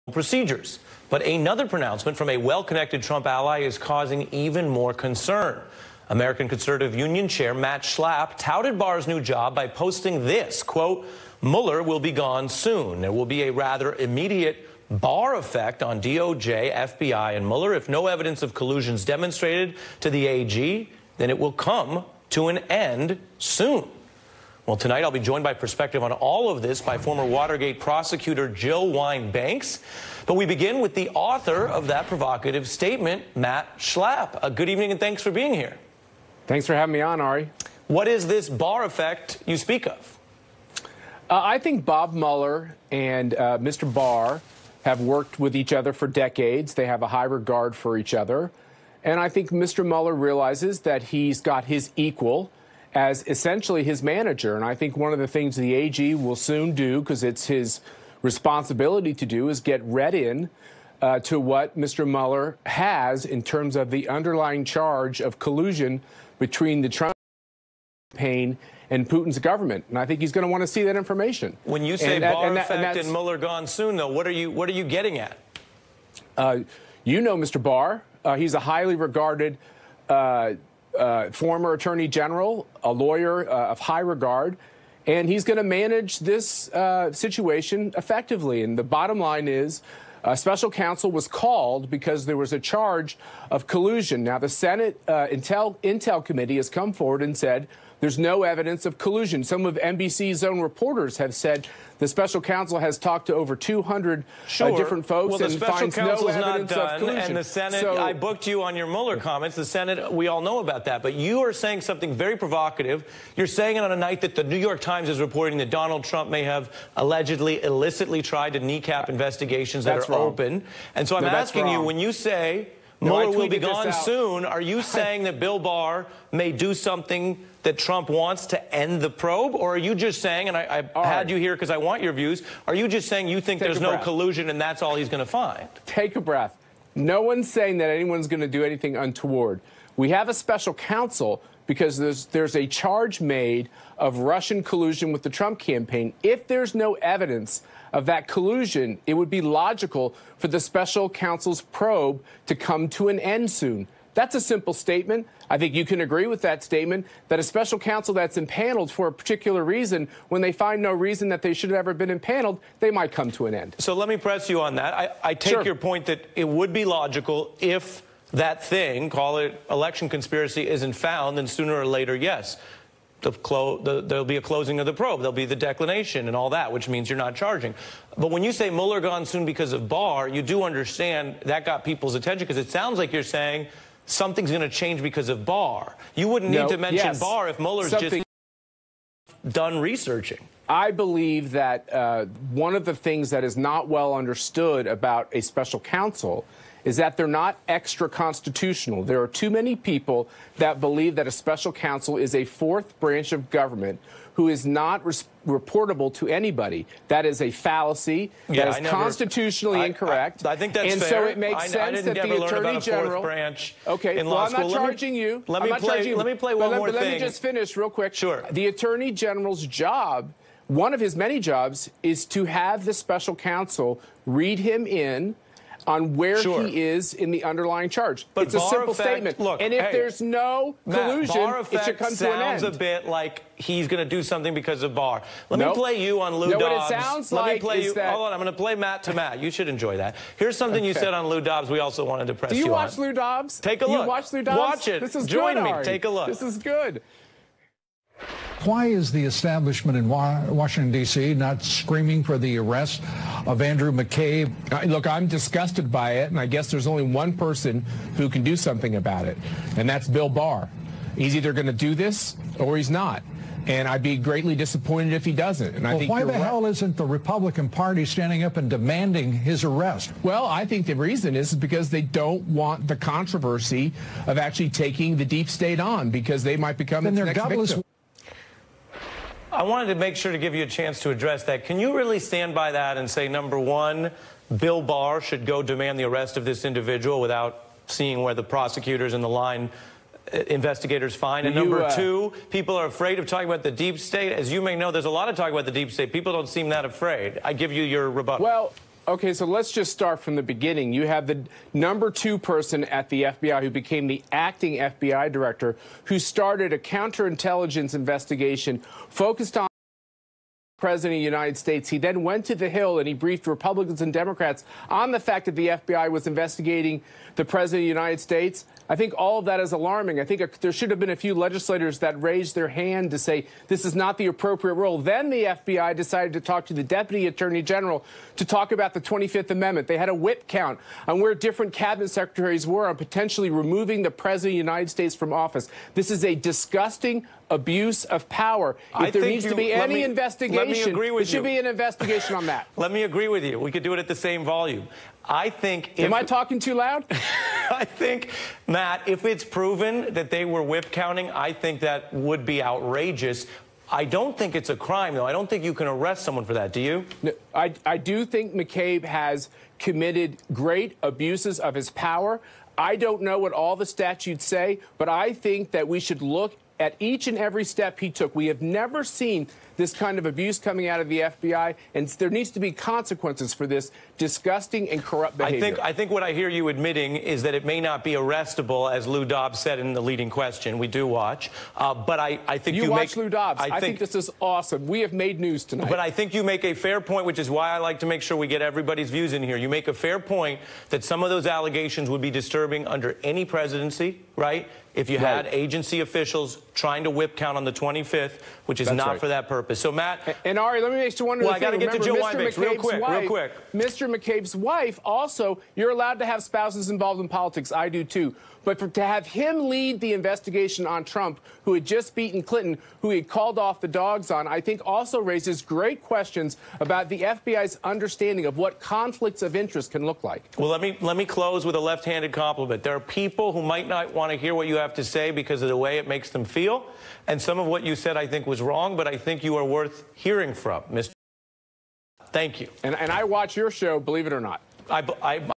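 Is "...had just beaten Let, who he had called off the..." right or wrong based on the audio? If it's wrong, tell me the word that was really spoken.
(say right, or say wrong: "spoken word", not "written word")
wrong: "Clinton", not "Let".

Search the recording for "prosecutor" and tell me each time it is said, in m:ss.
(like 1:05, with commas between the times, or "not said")
0:27, 4:48.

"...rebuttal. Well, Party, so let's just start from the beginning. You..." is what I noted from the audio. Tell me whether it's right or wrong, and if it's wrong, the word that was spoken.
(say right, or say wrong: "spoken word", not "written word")
wrong: "Okay", not "Party".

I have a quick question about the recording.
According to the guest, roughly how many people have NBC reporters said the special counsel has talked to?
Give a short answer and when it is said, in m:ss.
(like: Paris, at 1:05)
200, at 1:43.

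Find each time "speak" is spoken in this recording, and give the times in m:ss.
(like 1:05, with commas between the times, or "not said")
0:39.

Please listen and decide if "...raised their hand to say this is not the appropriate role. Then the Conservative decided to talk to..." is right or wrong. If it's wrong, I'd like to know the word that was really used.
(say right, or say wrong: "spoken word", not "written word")
wrong: "FBI", not "Conservative".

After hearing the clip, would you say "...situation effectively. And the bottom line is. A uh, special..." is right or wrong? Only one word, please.
right.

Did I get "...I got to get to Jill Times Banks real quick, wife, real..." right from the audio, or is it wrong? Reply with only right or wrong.
wrong.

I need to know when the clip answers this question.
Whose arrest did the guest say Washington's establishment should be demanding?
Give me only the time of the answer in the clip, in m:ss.
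4:13.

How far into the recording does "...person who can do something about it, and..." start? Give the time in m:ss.
4:17.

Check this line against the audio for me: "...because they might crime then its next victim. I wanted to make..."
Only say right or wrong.
wrong.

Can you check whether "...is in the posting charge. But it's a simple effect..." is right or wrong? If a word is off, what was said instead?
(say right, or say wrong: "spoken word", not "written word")
wrong: "underlying", not "posting".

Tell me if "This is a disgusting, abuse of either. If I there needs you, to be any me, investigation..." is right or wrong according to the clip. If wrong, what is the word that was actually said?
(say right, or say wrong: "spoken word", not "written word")
wrong: "power", not "either".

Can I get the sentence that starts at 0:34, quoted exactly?
A uh, good evening and thanks for being here.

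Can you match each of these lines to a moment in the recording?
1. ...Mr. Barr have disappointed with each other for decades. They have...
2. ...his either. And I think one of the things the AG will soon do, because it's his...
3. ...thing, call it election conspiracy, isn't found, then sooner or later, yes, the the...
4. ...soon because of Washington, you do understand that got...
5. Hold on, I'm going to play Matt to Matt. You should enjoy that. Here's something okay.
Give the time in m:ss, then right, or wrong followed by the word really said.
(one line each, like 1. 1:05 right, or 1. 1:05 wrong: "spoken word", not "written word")
1. 0:43 wrong: "worked", not "disappointed"
2. 0:53 wrong: "manager", not "either"
3. 2:48 right
4. 2:59 wrong: "Barr", not "Washington"
5. 3:58 right.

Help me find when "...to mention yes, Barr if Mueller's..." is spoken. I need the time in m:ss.
3:06.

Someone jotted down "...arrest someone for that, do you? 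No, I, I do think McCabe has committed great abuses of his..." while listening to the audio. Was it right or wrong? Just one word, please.
right.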